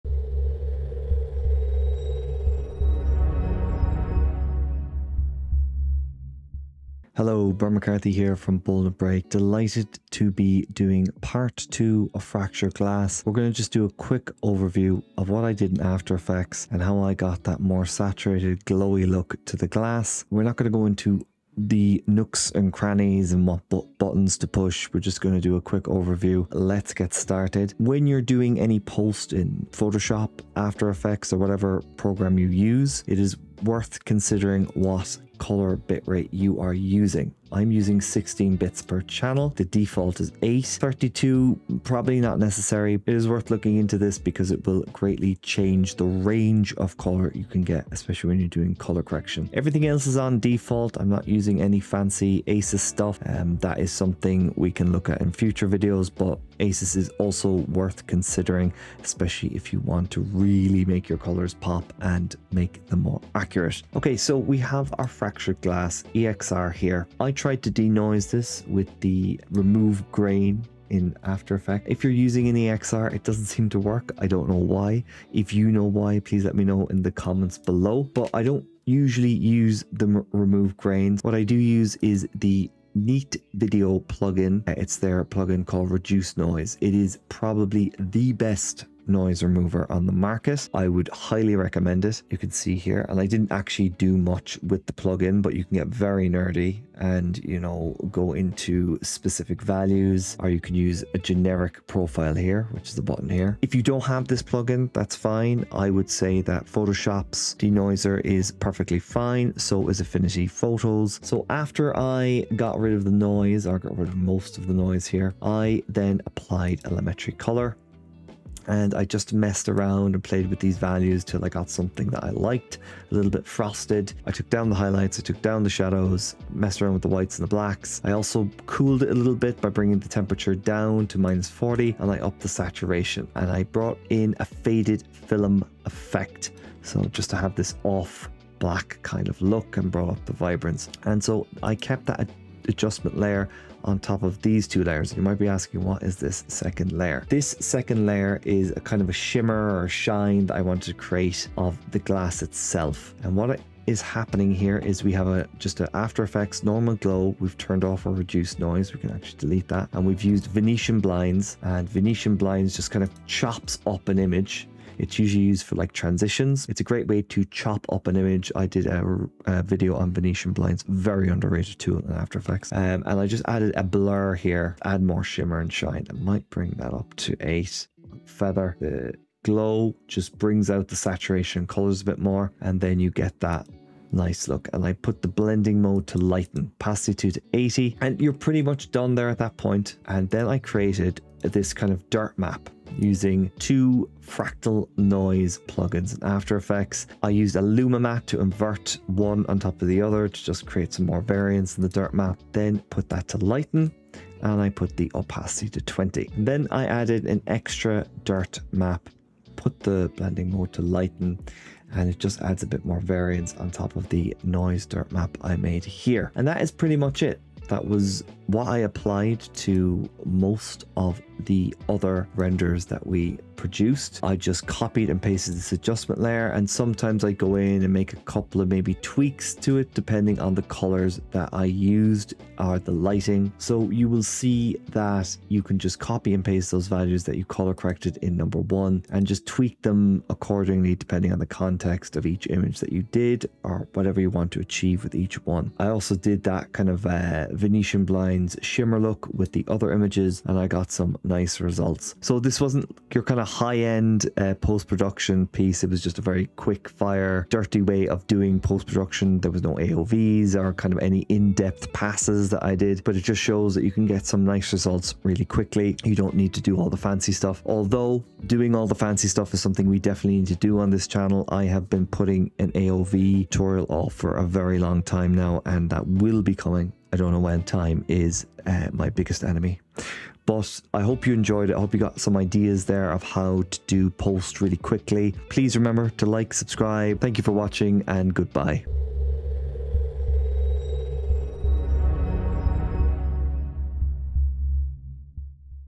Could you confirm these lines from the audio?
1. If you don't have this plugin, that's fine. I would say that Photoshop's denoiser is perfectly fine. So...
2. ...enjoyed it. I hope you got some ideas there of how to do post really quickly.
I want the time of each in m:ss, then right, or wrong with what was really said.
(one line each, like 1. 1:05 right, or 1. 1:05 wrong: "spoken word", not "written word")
1. 1:43 right
2. 4:41 right.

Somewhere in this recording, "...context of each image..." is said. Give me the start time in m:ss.
4:01.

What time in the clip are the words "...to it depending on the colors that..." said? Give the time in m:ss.
3:49.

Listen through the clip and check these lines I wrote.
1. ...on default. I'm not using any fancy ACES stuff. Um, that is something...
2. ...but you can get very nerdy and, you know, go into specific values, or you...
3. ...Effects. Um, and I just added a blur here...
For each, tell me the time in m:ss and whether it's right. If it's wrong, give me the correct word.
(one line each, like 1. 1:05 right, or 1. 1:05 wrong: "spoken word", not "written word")
1. 0:50 right
2. 1:35 right
3. 2:52 right.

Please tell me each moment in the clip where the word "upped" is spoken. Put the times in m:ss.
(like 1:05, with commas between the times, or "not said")
2:12.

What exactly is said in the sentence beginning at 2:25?
You might be asking, what is this second layer?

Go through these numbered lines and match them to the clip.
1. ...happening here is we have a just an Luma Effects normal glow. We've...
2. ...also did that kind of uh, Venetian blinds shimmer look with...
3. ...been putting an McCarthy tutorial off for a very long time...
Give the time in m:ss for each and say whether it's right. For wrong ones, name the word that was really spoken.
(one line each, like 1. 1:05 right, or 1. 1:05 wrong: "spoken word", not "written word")
1. 2:34 wrong: "After", not "Luma"
2. 4:05 right
3. 4:31 wrong: "AOV", not "McCarthy".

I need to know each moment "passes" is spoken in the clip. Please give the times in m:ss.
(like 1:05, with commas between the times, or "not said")
4:21.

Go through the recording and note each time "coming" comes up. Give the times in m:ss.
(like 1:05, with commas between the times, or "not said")
4:36.